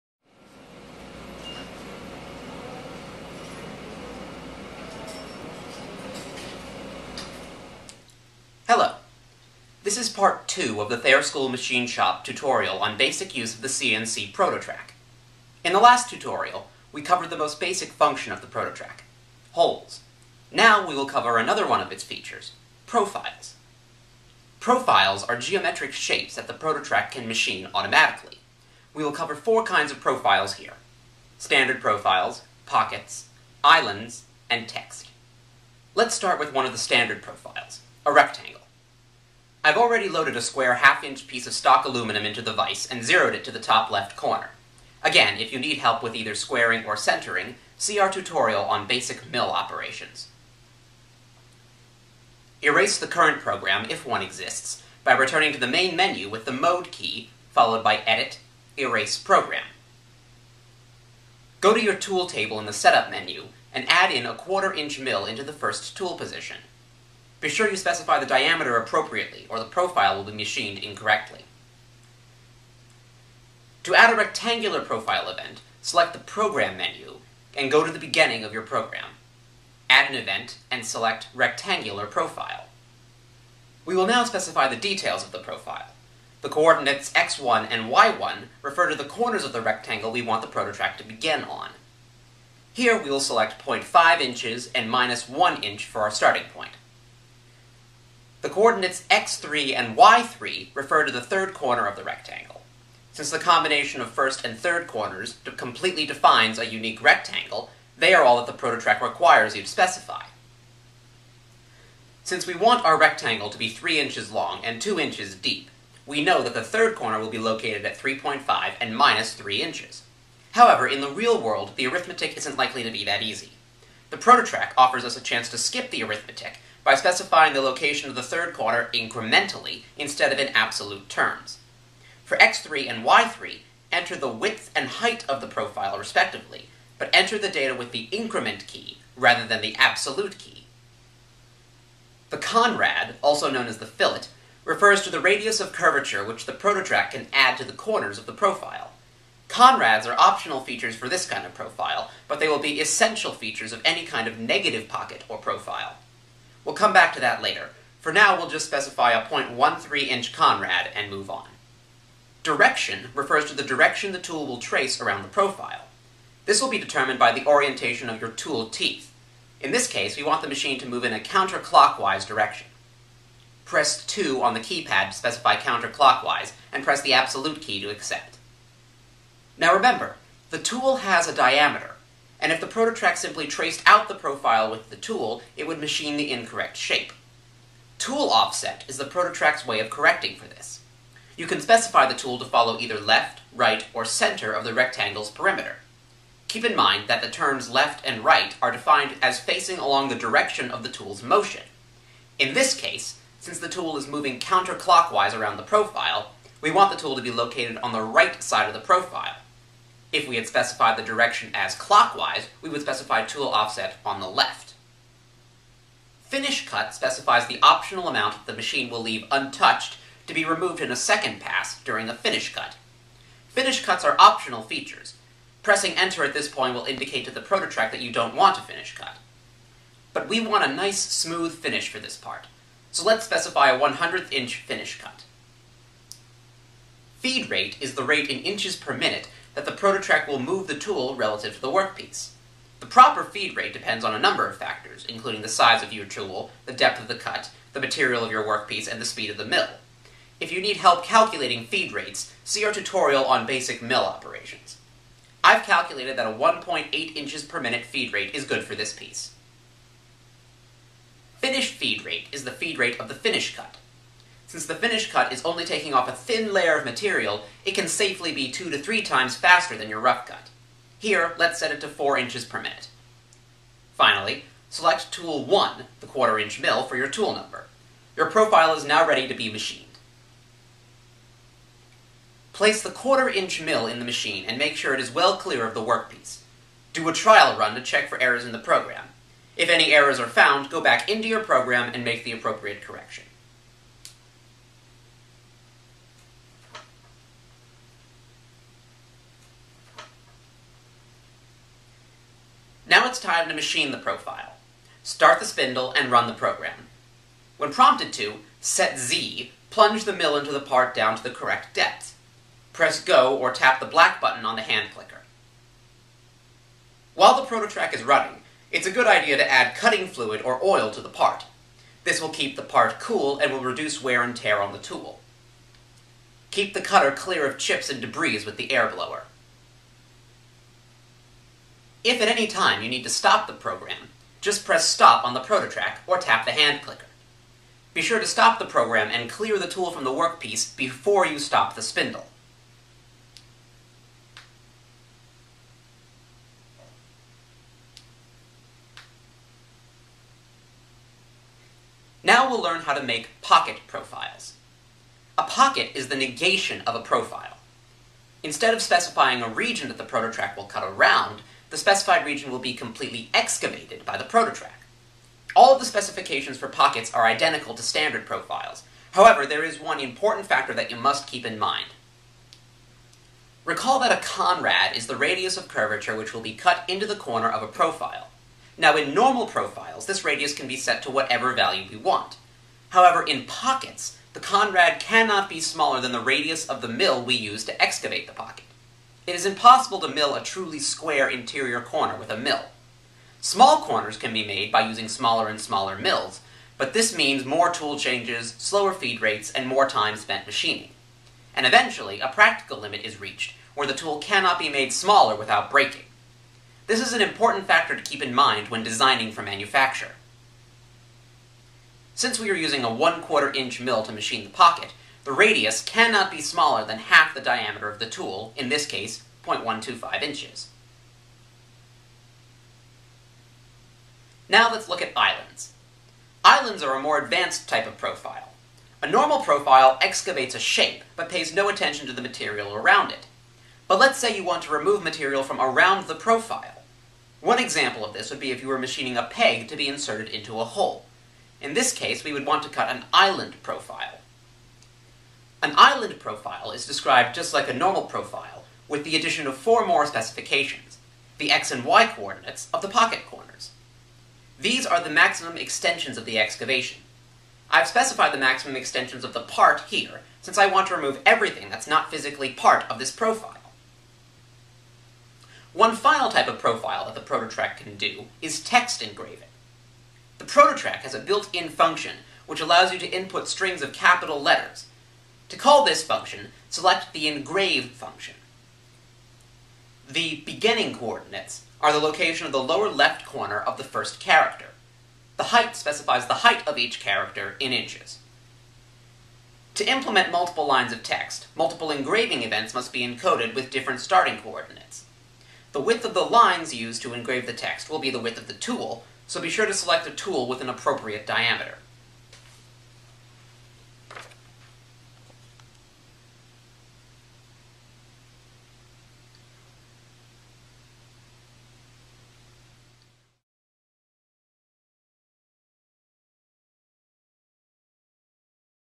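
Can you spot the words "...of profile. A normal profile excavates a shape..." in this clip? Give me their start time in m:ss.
7:07.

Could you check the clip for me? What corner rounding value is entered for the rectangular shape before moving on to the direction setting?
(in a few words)
0.13 inch.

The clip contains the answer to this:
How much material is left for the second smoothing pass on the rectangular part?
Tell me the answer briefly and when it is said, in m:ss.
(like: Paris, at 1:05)
1/100 inch, at 3:53.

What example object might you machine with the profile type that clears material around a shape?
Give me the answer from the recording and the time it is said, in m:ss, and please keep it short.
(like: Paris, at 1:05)
a peg, at 7:19.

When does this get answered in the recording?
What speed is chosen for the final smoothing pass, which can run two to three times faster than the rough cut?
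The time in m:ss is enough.
4:31.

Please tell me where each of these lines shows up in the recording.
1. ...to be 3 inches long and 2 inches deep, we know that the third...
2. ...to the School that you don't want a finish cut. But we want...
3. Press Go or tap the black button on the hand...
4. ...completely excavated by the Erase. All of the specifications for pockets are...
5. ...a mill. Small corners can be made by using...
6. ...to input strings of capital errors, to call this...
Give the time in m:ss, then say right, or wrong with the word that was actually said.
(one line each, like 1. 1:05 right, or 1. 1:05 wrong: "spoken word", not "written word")
1. 1:53 right
2. 3:47 wrong: "ProtoTRAK", not "School"
3. 5:12 right
4. 6:02 wrong: "ProtoTRAK", not "Erase"
5. 6:32 right
6. 7:52 wrong: "letters", not "errors".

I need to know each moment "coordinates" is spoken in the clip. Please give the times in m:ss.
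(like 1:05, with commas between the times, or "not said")
1:26, 1:38, 7:32, 8:00, 8:14.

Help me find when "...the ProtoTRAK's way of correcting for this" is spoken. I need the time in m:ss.
3:08.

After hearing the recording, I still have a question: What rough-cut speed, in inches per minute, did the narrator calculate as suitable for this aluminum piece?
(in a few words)
1.8 inches per minute.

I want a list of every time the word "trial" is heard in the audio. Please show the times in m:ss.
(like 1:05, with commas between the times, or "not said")
4:47.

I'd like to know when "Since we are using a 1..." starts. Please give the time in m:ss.
6:52.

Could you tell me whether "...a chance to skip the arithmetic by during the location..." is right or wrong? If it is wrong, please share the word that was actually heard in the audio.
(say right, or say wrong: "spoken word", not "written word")
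wrong: "specifying", not "during".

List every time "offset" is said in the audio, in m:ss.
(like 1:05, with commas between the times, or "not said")
3:08, 3:33.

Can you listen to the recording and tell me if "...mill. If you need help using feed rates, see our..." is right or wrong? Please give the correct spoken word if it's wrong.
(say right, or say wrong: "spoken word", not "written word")
wrong: "calculating", not "using".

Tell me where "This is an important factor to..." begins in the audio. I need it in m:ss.
6:46.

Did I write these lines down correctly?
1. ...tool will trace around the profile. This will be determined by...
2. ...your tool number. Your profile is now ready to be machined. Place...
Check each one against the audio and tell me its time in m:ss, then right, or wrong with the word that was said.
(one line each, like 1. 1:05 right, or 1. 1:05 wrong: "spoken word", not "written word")
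1. 2:44 right
2. 4:36 right.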